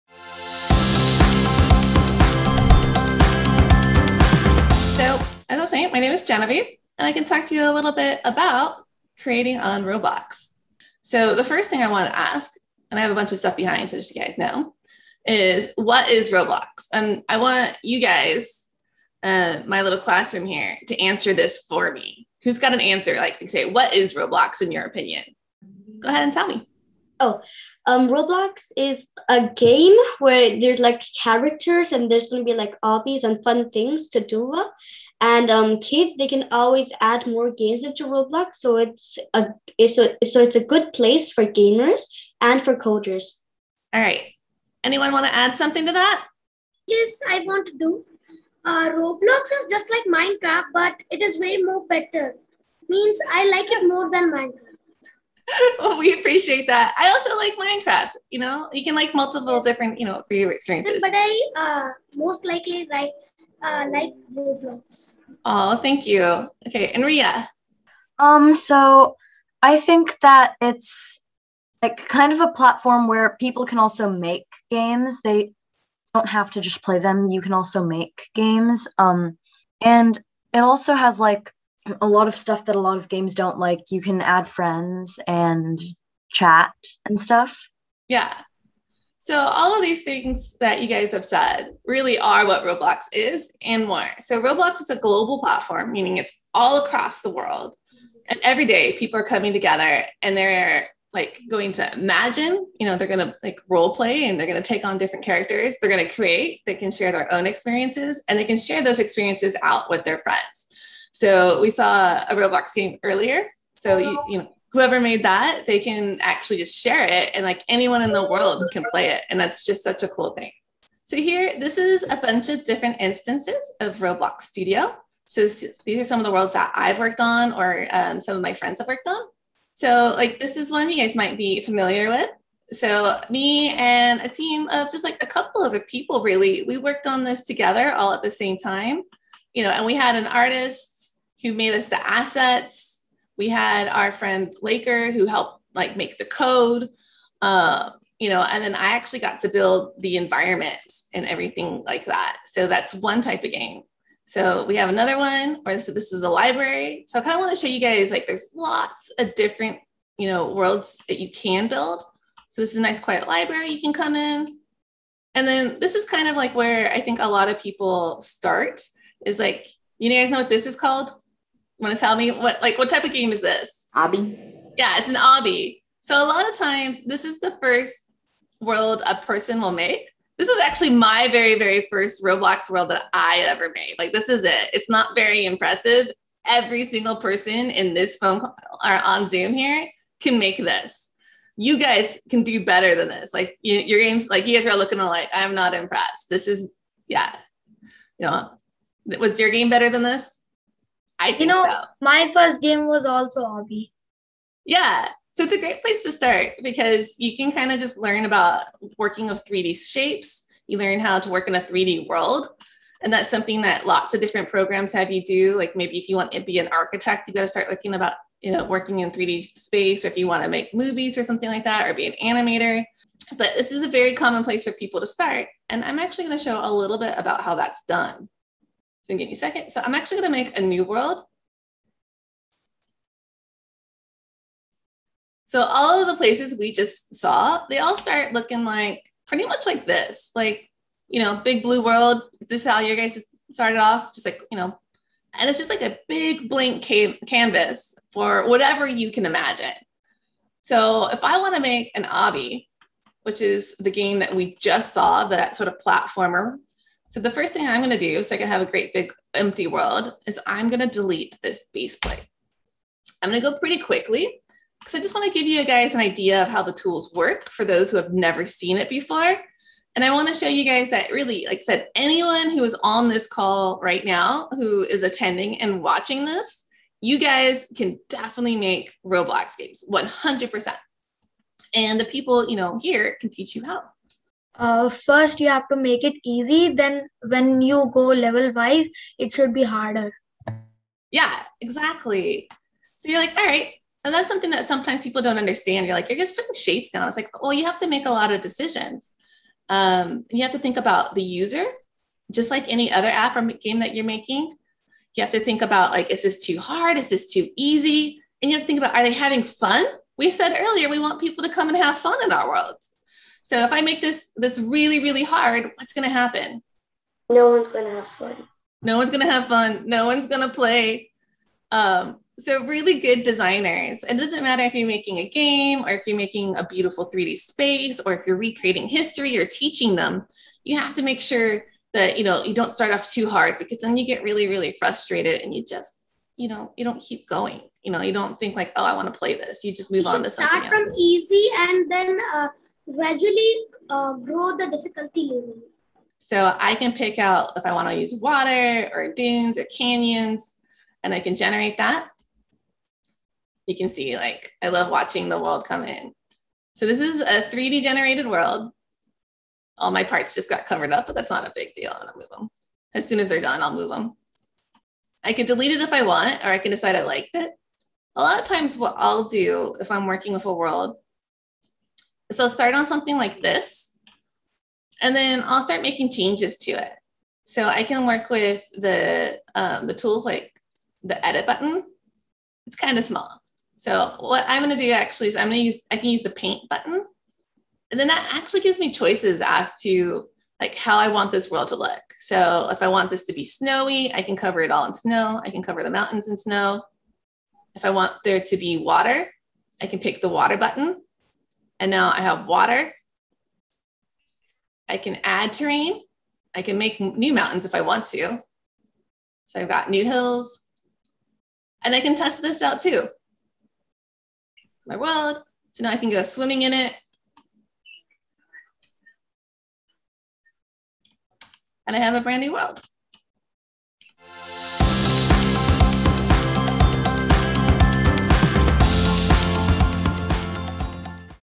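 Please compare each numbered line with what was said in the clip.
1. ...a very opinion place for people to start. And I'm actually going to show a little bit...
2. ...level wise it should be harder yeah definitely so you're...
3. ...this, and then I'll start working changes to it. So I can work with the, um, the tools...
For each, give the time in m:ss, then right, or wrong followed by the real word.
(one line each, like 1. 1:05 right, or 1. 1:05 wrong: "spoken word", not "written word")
1. 3:43 wrong: "common", not "opinion"
2. 4:48 wrong: "exactly", not "definitely"
3. 6:13 wrong: "making", not "working".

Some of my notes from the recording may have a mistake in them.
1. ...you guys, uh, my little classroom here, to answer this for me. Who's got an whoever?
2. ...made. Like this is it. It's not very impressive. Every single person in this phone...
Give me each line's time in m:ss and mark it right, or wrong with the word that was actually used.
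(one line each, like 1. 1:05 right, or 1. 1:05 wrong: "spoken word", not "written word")
1. 0:17 wrong: "answer", not "whoever"
2. 3:03 right.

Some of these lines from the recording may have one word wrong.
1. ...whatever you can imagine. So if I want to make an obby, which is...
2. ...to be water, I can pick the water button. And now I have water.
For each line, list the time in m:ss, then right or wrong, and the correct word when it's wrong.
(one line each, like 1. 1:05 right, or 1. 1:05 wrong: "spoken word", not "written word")
1. 4:08 right
2. 6:38 right.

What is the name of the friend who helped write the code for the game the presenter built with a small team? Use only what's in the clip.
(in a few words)
Laker.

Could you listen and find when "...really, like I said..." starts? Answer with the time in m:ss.
4:31.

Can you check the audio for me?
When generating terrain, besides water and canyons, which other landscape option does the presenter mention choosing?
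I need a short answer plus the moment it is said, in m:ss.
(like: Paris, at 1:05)
Dunes, at 5:49.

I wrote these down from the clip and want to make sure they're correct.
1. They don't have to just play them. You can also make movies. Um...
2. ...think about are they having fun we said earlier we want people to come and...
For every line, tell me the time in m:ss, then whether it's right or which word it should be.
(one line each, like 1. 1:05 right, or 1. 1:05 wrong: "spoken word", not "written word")
1. 1:15 wrong: "games", not "movies"
2. 5:08 right.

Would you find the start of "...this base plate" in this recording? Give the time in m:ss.
4:21.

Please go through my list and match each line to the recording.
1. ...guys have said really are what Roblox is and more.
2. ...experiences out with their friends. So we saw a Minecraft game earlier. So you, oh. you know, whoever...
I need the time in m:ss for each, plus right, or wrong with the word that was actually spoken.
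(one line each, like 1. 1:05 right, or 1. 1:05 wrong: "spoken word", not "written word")
1. 1:30 right
2. 1:48 wrong: "Roblox", not "Minecraft".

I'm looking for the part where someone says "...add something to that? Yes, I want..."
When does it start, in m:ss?
0:45.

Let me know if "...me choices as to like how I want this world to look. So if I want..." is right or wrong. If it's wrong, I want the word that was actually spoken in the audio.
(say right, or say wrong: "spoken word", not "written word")
right.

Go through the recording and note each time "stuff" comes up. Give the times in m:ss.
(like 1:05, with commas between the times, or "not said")
0:13, 1:22, 1:27.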